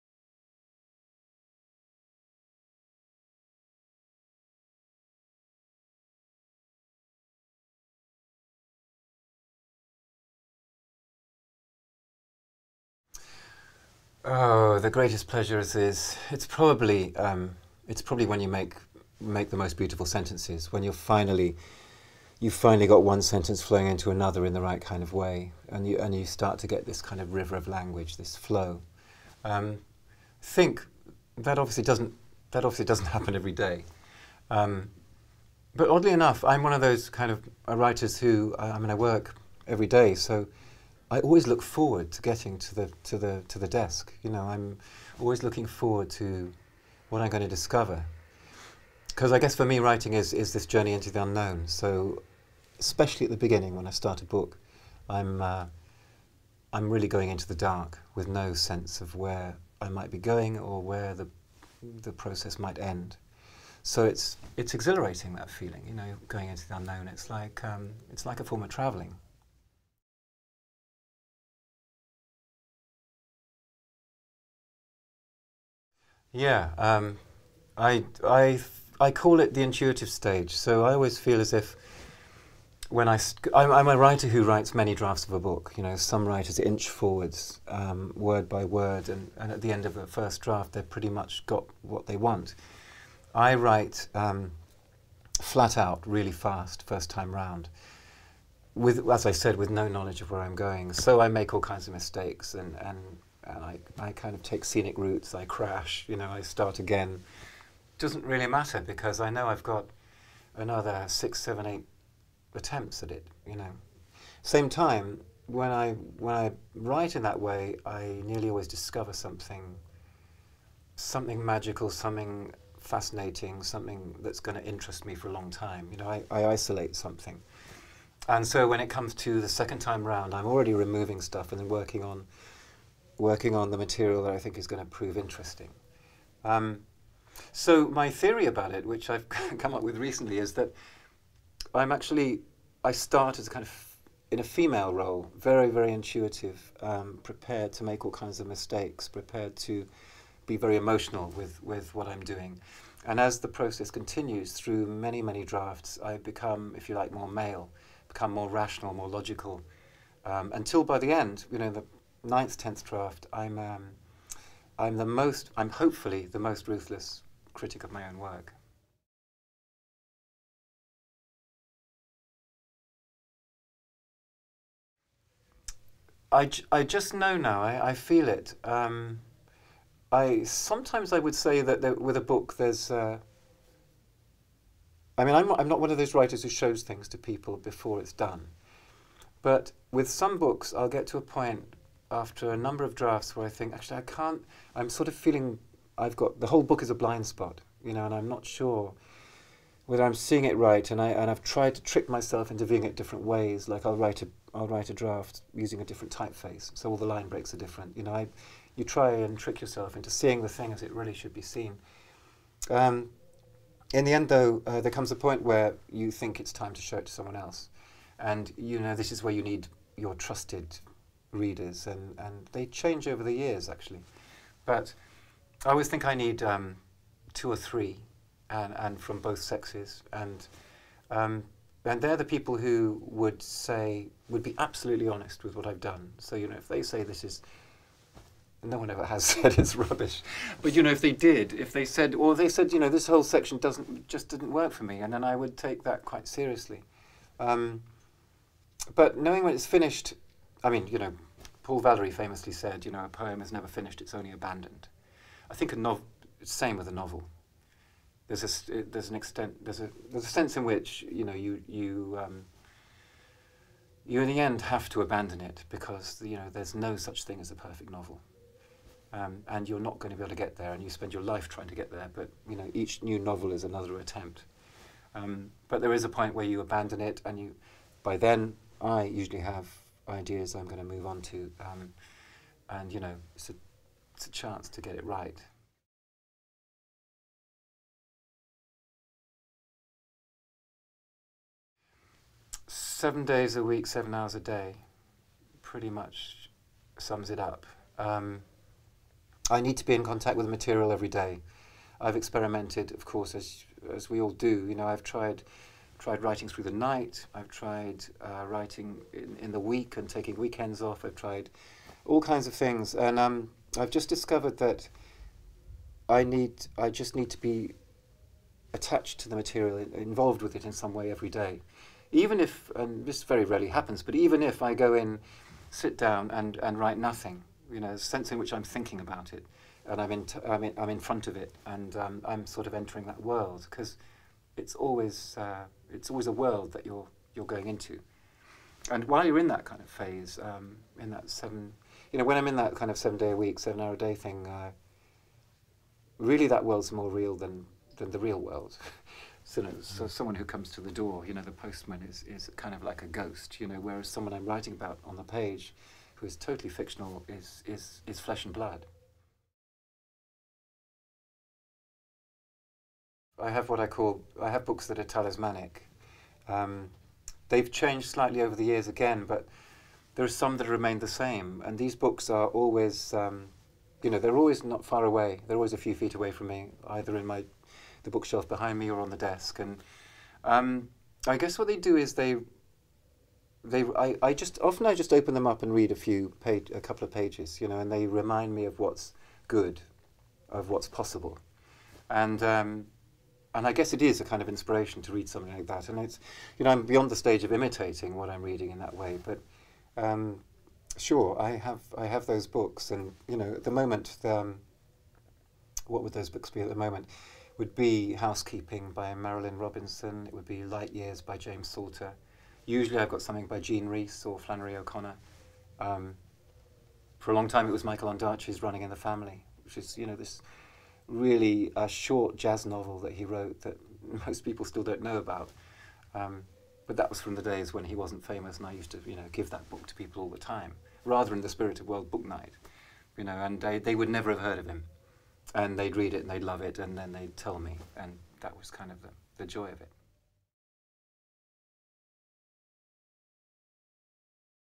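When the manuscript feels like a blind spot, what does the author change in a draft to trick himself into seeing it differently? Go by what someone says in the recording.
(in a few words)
a different typeface.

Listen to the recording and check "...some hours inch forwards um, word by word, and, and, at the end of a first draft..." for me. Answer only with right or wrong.
wrong.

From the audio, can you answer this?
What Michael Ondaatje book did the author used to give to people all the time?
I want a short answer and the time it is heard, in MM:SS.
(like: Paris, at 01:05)
Running in the Family, at 06:58.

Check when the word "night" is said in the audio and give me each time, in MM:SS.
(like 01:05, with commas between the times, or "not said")
05:06, 07:12.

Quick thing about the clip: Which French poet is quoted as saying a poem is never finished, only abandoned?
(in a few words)
Paul Valery.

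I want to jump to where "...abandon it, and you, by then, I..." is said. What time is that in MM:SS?
04:36.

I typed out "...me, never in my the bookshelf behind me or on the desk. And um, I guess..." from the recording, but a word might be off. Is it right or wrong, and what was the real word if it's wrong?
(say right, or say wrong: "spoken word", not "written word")
wrong: "either", not "never".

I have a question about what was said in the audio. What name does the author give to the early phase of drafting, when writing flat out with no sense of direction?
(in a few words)
the intuitive stage.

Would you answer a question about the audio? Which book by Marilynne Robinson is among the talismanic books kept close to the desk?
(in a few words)
Housekeeping.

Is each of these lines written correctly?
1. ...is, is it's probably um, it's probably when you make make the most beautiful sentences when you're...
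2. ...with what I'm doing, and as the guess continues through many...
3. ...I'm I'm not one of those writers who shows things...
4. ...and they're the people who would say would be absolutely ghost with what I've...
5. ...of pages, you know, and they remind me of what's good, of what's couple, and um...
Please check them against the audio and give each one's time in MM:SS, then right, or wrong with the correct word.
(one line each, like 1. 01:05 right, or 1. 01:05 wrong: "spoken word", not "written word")
1. 00:15 right
2. 02:31 wrong: "process", not "guess"
3. 03:05 right
4. 03:51 wrong: "honest", not "ghost"
5. 06:27 wrong: "possible", not "couple".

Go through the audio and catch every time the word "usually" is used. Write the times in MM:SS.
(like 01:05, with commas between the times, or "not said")
04:39, 06:52.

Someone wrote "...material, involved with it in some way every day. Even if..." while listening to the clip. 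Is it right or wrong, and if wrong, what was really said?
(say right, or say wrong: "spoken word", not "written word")
right.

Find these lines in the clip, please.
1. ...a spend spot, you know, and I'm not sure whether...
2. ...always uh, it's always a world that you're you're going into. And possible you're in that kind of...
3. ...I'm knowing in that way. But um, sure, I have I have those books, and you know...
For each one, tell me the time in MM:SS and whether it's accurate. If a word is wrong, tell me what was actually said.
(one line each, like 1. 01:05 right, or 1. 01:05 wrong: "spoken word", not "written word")
1. 03:16 wrong: "blind", not "spend"
2. 05:34 wrong: "while", not "possible"
3. 06:38 wrong: "reading", not "knowing".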